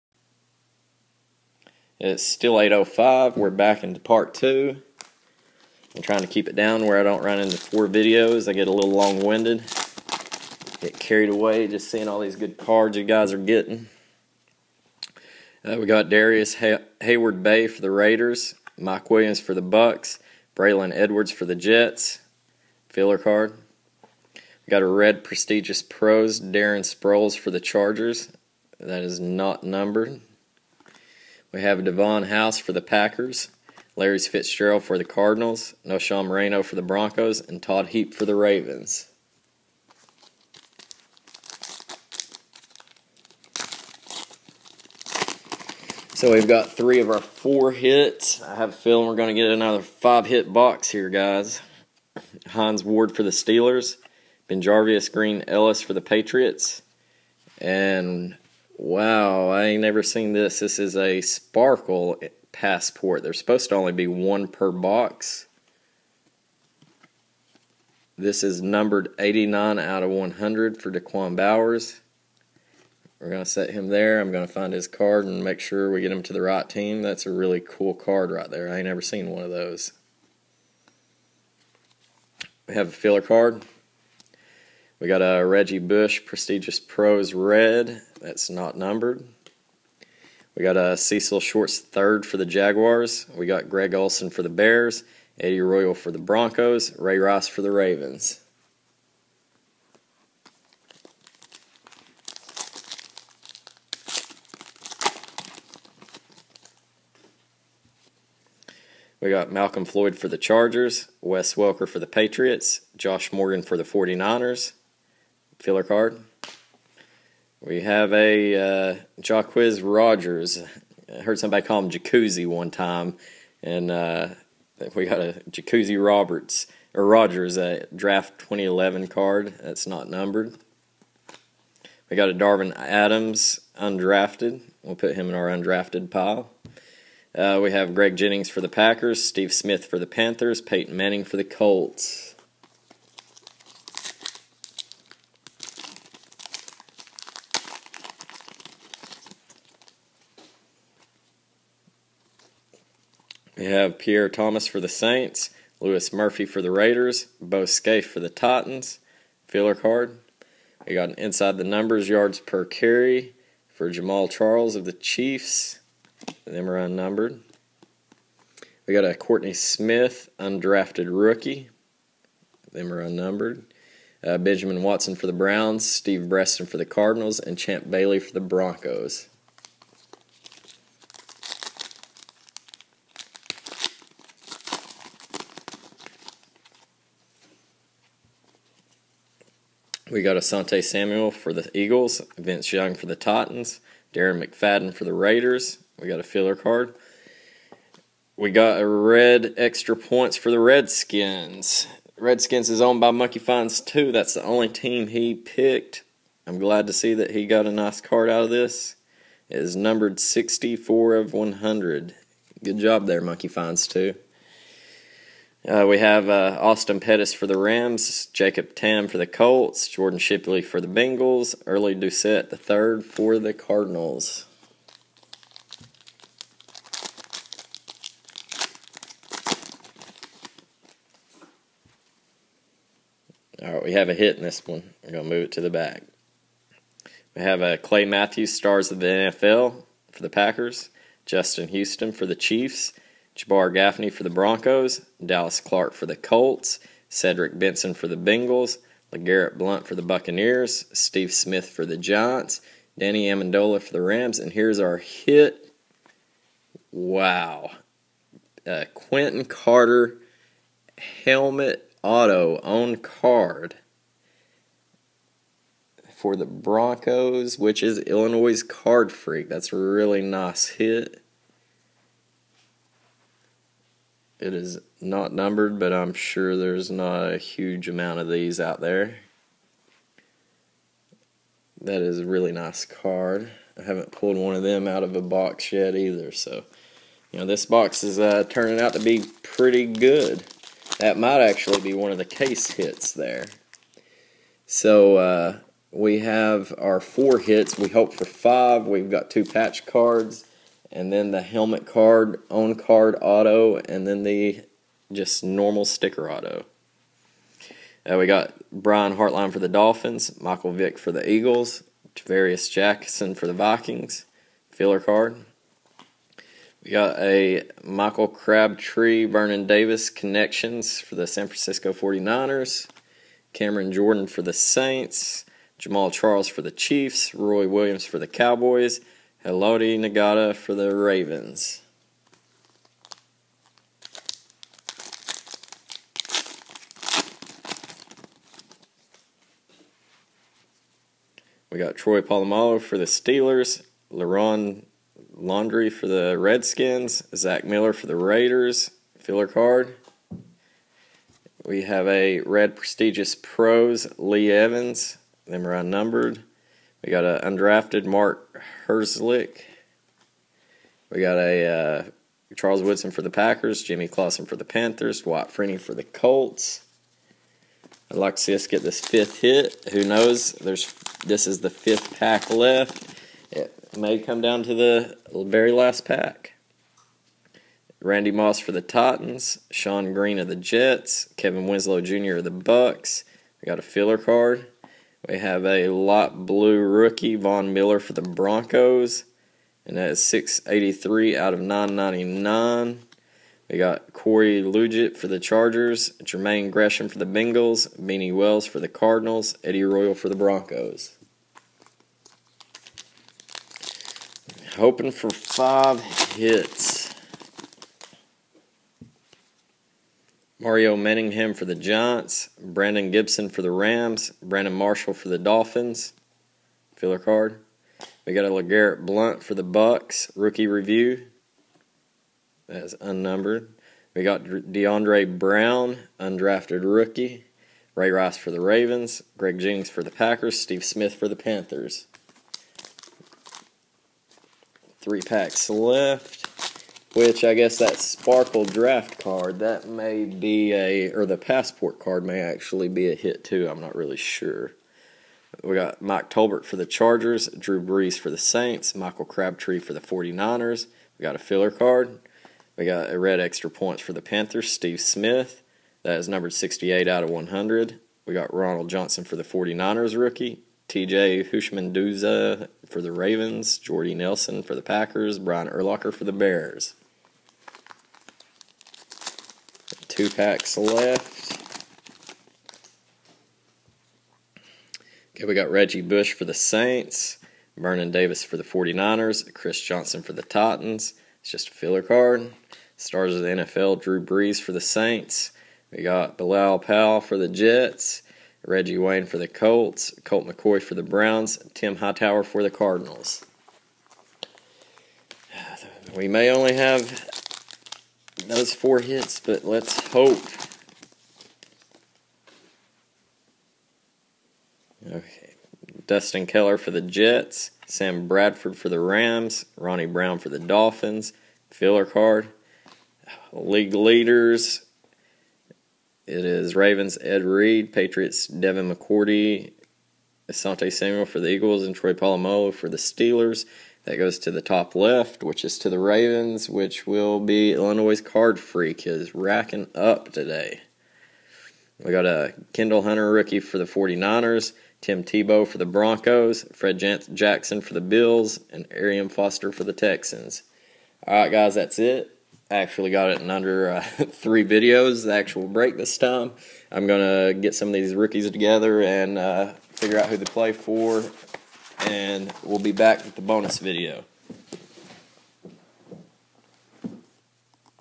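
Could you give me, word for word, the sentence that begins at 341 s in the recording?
We got Troy Polamalu for the Steelers, LaRon Landry for the Redskins, Zach Miller for the Raiders, filler card.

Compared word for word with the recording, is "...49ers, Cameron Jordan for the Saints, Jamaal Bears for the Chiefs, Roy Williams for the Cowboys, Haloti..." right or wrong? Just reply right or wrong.
wrong.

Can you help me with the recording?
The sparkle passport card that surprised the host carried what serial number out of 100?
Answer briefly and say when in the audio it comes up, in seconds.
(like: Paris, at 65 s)
89, at 69 s.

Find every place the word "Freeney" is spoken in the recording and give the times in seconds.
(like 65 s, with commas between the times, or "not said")
365 s.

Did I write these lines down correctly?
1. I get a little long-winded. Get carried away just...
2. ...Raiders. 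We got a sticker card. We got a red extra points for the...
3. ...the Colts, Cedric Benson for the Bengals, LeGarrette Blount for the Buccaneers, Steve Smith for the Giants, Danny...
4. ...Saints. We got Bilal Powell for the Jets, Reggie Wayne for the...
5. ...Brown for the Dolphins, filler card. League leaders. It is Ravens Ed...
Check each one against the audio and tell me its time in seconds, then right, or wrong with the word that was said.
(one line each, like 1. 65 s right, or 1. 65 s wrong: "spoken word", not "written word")
1. 8 s right
2. 195 s wrong: "filler", not "sticker"
3. 246 s right
4. 484 s right
5. 510 s right.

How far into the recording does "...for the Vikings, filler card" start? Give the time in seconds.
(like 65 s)
313 s.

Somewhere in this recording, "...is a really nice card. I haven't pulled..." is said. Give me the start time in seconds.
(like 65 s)
282 s.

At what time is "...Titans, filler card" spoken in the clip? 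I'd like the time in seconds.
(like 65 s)
158 s.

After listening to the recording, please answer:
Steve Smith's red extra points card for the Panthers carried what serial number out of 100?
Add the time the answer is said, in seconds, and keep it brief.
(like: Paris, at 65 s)
68, at 456 s.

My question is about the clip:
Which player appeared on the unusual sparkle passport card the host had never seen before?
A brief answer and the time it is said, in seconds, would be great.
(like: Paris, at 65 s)
Da'Quan Bowers, at 70 s.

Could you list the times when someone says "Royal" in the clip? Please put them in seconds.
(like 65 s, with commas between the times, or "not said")
95 s, 399 s.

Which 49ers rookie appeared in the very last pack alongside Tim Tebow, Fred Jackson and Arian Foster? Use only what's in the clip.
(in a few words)
Kendall Hunter.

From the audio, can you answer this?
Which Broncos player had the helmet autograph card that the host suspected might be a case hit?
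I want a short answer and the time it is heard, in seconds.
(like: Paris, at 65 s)
Quinton Carter, at 258 s.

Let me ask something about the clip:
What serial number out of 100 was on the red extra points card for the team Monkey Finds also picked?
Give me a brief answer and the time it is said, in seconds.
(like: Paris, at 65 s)
64, at 210 s.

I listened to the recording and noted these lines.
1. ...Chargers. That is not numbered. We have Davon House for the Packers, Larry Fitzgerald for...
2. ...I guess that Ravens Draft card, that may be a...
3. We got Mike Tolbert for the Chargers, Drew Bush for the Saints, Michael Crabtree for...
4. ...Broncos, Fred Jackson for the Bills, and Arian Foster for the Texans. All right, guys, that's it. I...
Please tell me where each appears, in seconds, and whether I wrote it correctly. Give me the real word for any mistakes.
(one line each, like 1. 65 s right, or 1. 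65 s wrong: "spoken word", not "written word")
1. 27 s right
2. 437 s wrong: "Sparkle", not "Ravens"
3. 445 s wrong: "Brees", not "Bush"
4. 535 s right.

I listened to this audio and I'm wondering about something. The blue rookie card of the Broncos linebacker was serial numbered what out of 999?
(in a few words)
683.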